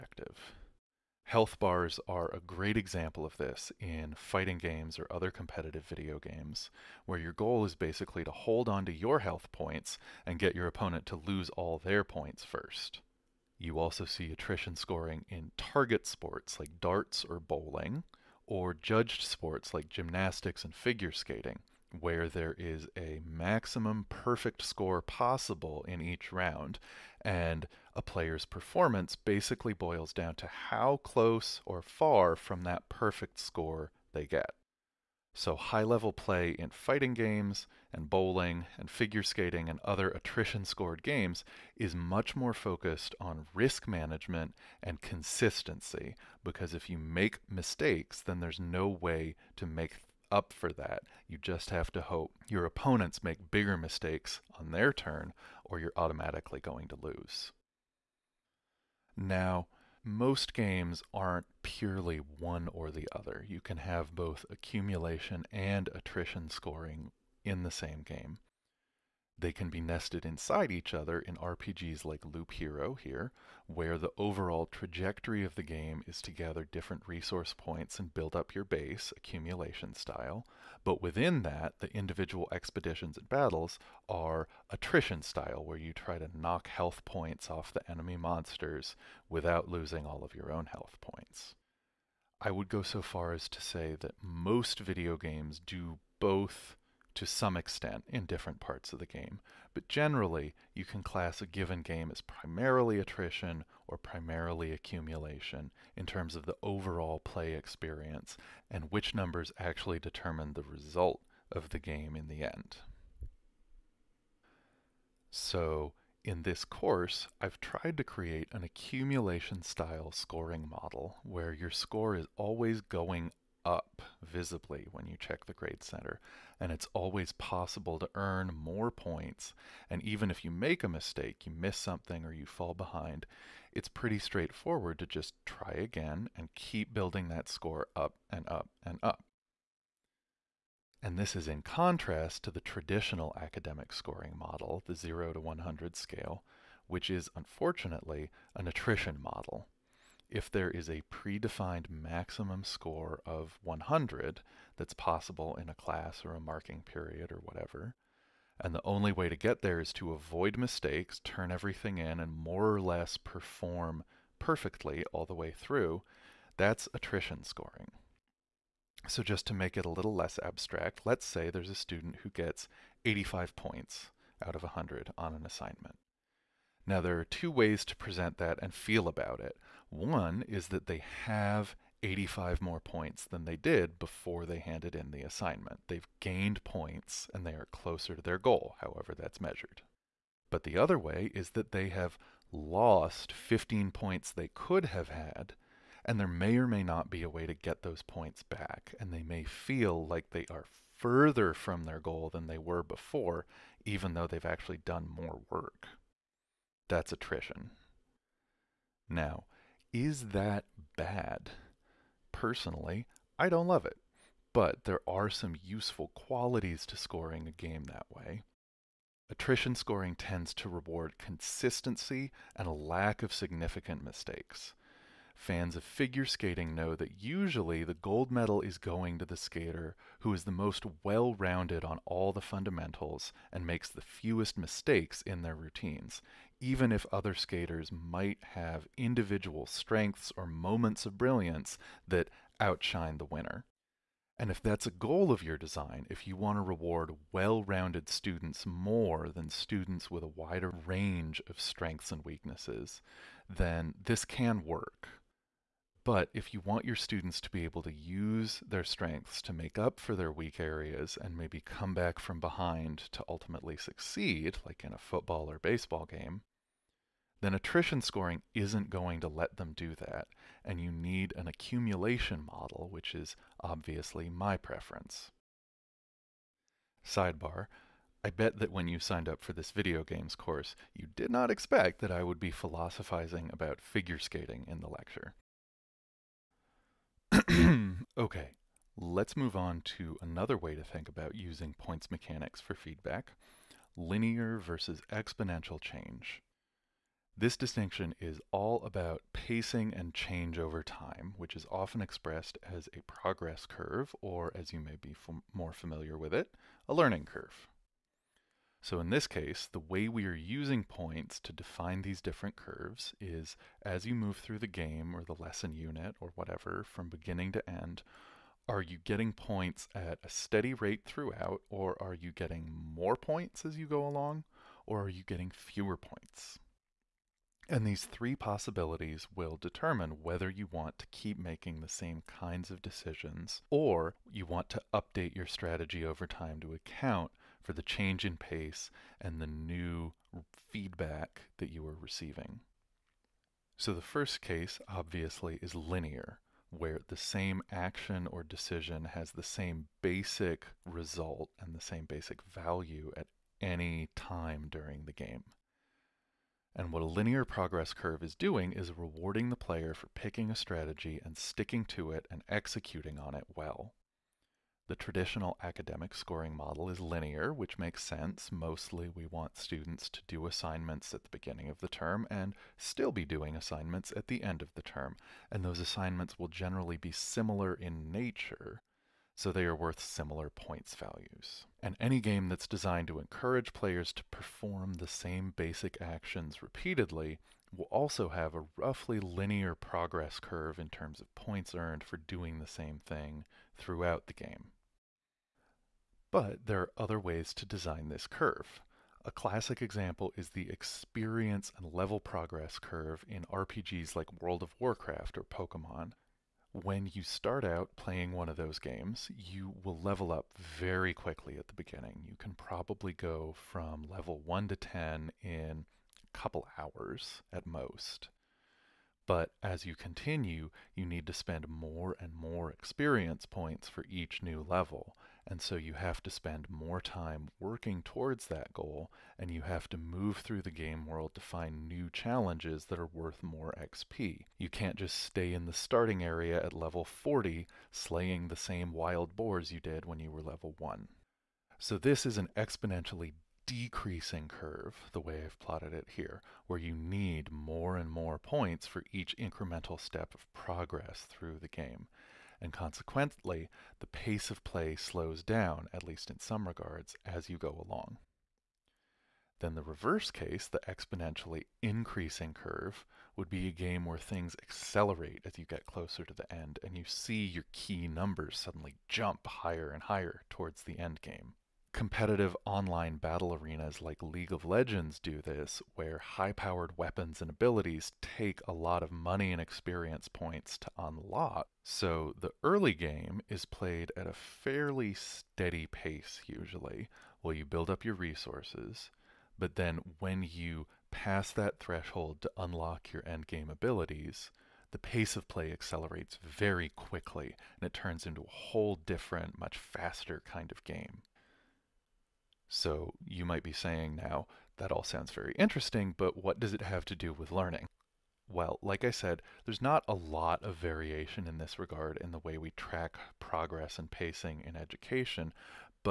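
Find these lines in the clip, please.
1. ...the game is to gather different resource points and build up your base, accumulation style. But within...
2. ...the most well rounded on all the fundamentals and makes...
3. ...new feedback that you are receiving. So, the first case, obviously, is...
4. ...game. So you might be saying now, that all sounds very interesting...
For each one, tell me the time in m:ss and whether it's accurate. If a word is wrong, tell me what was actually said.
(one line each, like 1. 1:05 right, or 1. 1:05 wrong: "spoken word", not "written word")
1. 1:15 right
2. 3:50 right
3. 5:39 right
4. 8:20 right.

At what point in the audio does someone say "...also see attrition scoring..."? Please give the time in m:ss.
0:13.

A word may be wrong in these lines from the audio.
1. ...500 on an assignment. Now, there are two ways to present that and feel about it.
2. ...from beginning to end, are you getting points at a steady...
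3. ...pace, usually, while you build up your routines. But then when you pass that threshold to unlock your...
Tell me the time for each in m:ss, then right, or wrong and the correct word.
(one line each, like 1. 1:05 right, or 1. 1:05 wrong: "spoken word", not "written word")
1. 2:54 wrong: "100", not "500"
2. 5:16 right
3. 8:05 wrong: "resources", not "routines".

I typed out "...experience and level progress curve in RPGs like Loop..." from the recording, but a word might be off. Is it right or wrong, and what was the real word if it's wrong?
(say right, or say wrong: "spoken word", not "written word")
wrong: "World", not "Loop".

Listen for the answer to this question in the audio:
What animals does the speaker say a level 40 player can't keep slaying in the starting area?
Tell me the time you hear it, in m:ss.
7:18.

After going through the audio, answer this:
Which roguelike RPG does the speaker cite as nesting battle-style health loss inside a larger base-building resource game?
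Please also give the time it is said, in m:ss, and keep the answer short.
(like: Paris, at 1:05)
Loop Hero, at 1:12.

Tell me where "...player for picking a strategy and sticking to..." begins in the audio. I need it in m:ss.
5:59.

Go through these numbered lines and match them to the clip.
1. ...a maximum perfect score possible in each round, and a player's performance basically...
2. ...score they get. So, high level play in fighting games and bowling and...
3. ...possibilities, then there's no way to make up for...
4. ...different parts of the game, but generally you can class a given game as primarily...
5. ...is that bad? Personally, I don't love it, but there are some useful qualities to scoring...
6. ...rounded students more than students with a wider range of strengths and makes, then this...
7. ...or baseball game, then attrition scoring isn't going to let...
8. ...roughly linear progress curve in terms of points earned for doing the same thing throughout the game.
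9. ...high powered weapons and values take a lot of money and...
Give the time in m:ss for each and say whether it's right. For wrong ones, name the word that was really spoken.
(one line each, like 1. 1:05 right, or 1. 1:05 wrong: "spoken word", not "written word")
1. 0:22 right
2. 0:33 right
3. 0:47 wrong: "mistakes", not "possibilities"
4. 1:38 right
5. 3:29 right
6. 4:07 wrong: "weaknesses", not "makes"
7. 4:25 right
8. 6:28 right
9. 7:56 wrong: "abilities", not "values".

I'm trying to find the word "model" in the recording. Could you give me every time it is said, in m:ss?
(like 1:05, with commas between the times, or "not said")
2:00, 2:24, 2:29, 4:32, 6:06.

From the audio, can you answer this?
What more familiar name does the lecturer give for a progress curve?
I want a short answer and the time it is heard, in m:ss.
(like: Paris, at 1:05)
Learning curve, at 5:06.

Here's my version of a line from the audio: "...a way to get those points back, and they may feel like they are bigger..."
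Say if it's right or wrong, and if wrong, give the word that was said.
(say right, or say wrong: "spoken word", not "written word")
wrong: "further", not "bigger".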